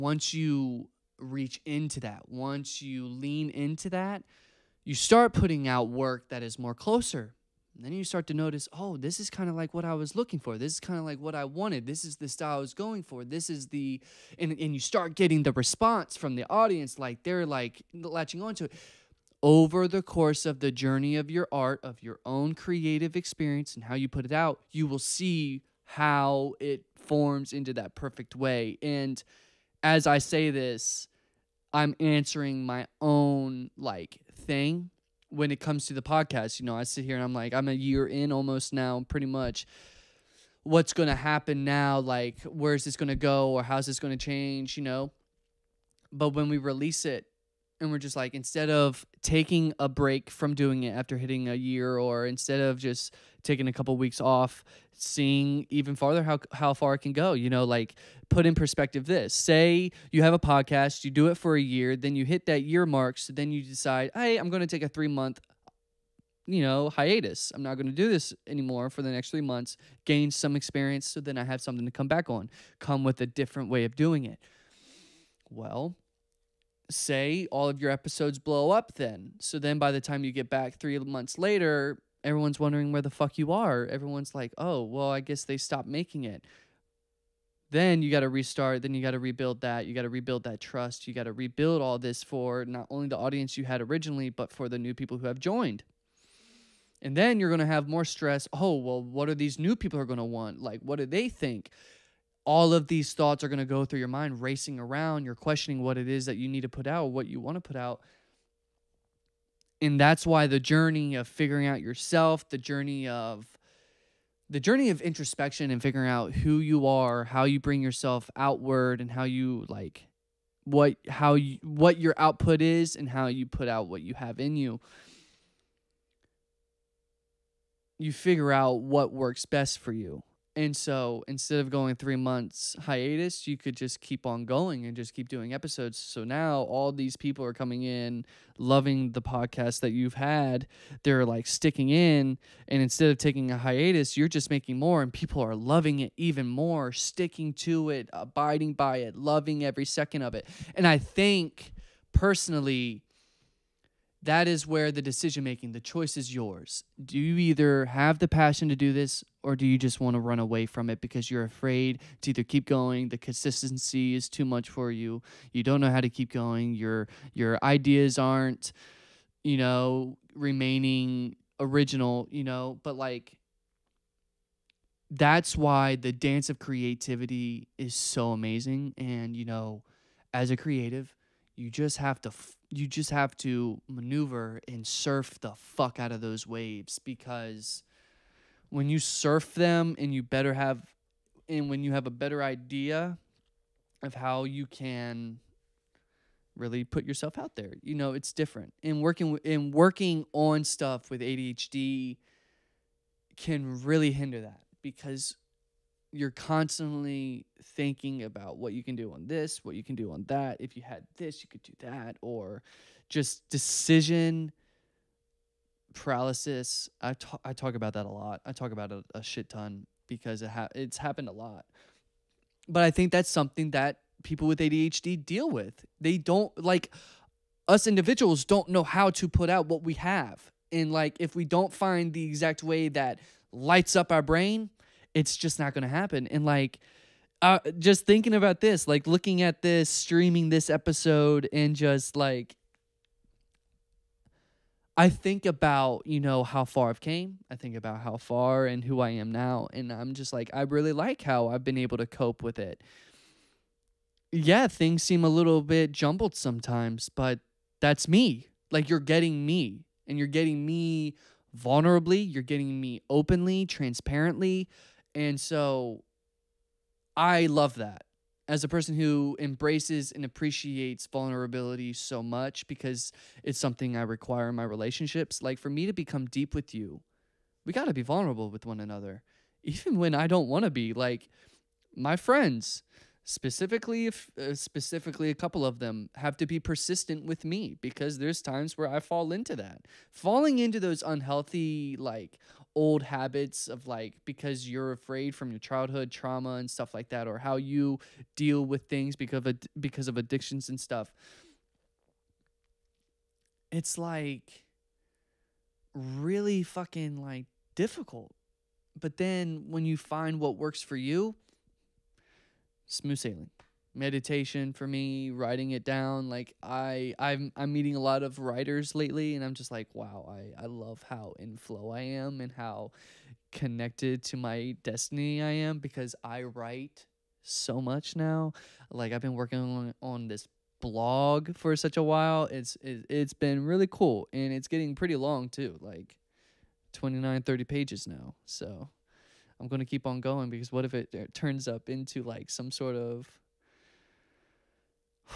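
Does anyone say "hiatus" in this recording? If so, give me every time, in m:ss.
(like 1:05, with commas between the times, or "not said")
1:06, 2:12, 2:23.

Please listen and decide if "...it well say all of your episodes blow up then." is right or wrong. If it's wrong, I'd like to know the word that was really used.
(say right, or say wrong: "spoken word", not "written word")
right.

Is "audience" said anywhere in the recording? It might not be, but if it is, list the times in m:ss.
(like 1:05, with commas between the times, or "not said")
0:16, 1:33.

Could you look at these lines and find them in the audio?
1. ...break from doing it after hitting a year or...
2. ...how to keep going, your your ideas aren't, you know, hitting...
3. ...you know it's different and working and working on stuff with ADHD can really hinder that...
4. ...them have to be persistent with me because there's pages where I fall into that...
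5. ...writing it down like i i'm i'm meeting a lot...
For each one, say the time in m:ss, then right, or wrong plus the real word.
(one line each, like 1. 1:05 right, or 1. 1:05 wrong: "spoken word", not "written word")
1. 0:49 right
2. 2:45 wrong: "remaining", not "hitting"
3. 3:17 right
4. 4:45 wrong: "times", not "pages"
5. 5:15 right.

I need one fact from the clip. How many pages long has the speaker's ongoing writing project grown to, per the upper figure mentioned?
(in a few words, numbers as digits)
30 pages.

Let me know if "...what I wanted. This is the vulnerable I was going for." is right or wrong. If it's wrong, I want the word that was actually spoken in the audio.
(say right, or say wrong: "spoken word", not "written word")
wrong: "style", not "vulnerable".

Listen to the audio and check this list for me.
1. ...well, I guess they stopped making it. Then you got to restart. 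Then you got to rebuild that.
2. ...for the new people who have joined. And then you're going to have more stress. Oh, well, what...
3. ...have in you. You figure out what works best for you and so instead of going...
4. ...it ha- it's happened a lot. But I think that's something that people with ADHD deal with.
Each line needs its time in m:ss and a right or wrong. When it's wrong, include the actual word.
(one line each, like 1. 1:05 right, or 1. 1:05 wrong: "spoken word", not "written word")
1. 1:24 right
2. 1:34 right
3. 2:04 right
4. 3:40 right.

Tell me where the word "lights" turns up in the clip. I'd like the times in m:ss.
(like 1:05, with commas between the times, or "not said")
3:53.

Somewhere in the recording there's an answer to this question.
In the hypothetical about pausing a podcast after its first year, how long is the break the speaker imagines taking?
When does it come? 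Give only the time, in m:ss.
1:04.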